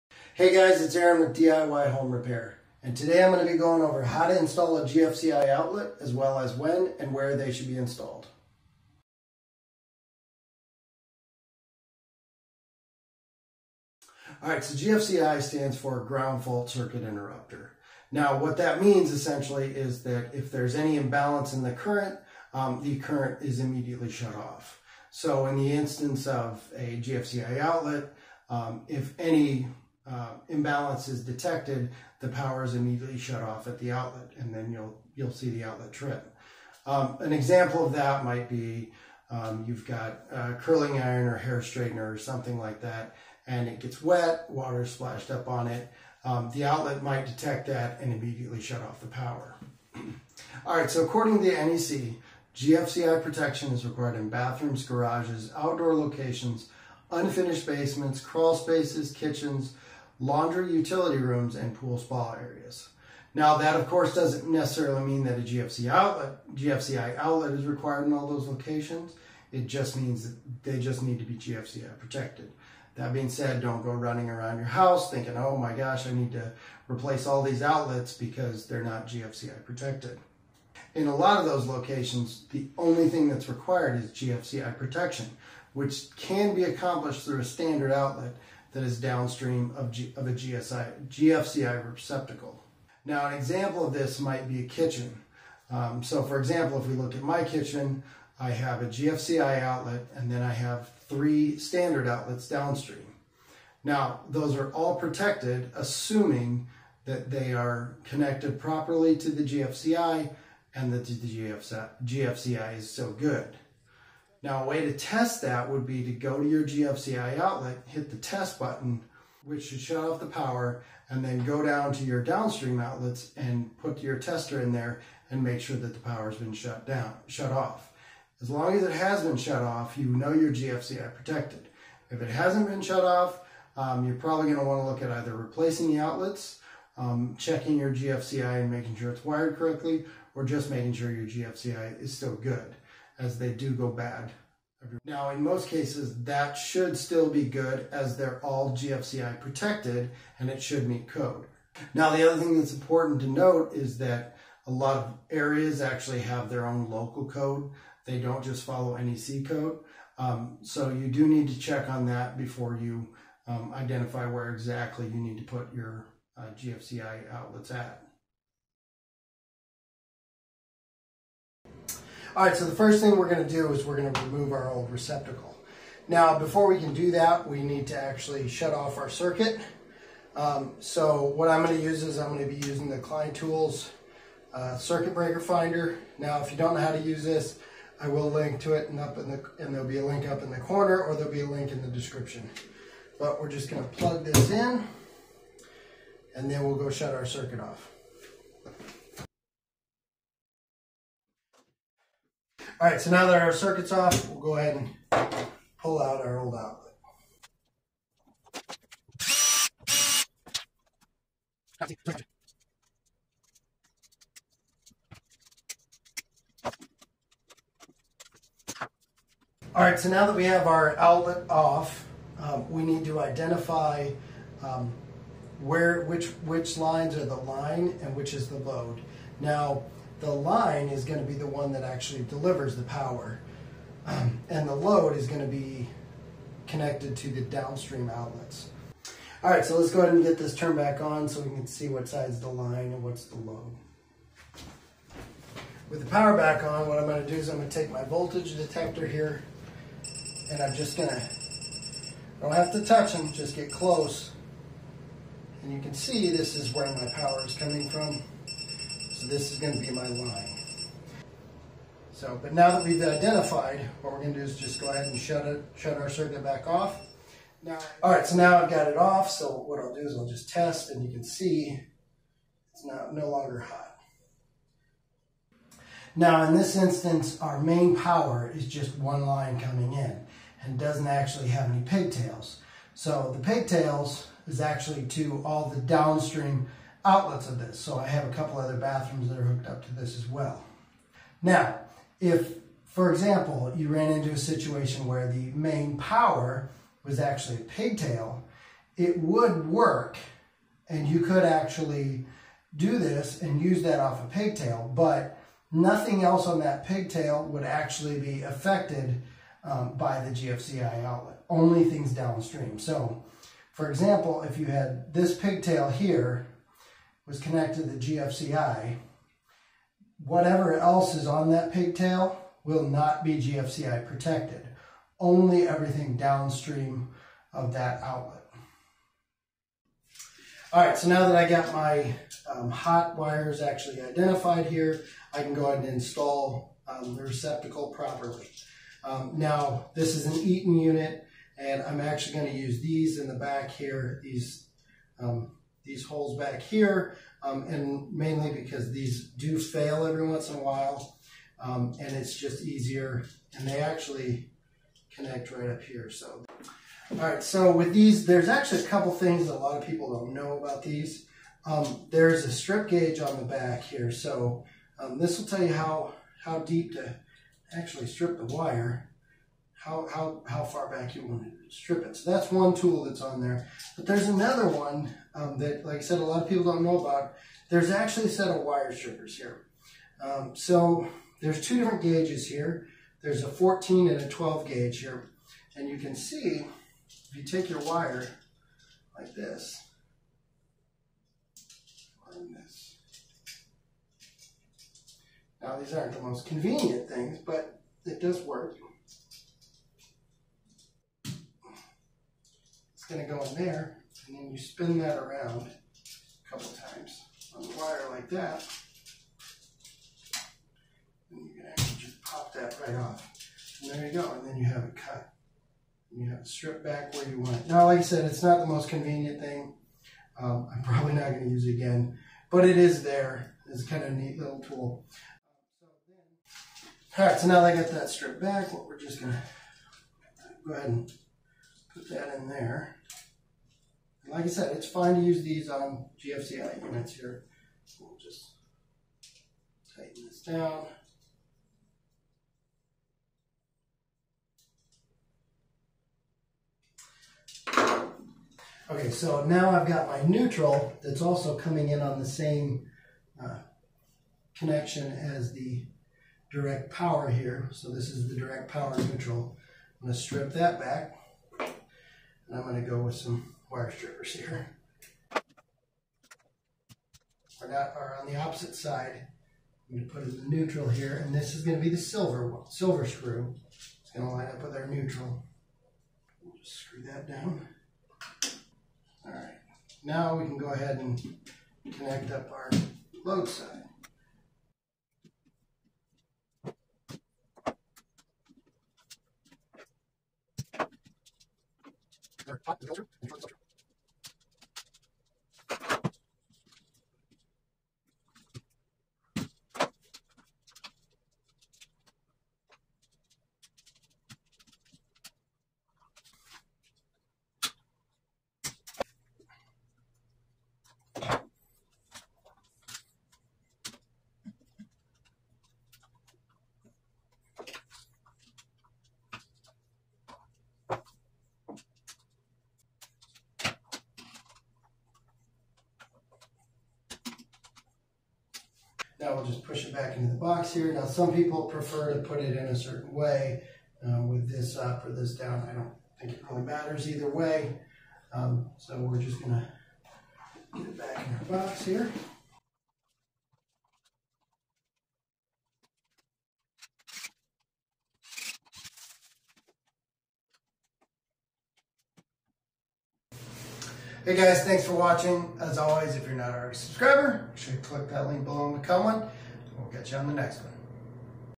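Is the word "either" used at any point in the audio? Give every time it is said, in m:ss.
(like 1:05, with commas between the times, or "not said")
2:15, 8:57.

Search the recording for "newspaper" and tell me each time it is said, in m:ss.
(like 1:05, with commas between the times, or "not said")
not said.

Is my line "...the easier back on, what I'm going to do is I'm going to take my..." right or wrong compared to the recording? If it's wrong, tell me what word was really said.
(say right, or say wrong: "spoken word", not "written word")
wrong: "power", not "easier".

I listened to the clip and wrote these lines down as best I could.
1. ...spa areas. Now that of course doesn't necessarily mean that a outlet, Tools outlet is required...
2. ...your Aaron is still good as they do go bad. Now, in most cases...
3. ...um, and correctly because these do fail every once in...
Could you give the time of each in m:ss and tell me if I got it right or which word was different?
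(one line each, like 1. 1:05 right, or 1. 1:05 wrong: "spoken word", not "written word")
1. 1:01 wrong: "GFCI", not "Tools"
2. 2:21 wrong: "GFCI", not "Aaron"
3. 5:47 wrong: "mainly", not "correctly".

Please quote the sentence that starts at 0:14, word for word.
Alright, so GFCI stands for Ground Fault Circuit Interrupter.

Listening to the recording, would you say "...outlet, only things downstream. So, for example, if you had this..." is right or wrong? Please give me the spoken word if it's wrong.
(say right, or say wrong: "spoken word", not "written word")
right.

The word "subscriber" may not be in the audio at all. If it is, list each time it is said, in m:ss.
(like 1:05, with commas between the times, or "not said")
9:16.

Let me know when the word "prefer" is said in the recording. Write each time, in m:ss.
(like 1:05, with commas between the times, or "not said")
8:51.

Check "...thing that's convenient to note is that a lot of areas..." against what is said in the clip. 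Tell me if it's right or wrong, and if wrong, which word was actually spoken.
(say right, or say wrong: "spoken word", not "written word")
wrong: "important", not "convenient".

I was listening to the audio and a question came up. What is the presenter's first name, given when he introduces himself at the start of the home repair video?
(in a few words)
Aaron.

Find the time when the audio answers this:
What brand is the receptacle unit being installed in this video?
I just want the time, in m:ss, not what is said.
5:40.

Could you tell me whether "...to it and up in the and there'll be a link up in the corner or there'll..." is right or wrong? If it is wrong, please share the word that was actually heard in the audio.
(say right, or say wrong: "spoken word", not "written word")
right.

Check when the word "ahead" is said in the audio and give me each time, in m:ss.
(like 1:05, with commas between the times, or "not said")
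3:24, 4:00, 4:24, 5:35, 7:10, 8:00.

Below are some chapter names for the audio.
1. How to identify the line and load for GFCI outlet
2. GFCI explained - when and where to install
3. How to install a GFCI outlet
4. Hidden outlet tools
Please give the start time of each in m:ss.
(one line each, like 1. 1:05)
1. 3:43
2. 0:14
3. 2:51
4. 5:57.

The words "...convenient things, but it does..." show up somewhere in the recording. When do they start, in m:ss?
6:36.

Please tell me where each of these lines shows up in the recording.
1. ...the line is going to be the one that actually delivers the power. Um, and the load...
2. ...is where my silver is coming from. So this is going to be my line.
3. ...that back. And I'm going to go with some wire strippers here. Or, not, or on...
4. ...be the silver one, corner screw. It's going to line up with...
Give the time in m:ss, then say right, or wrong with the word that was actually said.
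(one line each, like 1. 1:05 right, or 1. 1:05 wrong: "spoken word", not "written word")
1. 3:50 right
2. 4:16 wrong: "power", not "silver"
3. 7:40 right
4. 7:51 wrong: "silver", not "corner".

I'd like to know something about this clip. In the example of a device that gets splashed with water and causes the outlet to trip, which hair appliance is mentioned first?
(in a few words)
curling iron.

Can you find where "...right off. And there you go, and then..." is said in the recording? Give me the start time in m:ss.
6:52.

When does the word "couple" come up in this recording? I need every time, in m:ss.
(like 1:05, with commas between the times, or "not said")
4:48, 5:58, 6:46.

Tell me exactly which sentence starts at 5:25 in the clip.
Only everything downstream of that outlet.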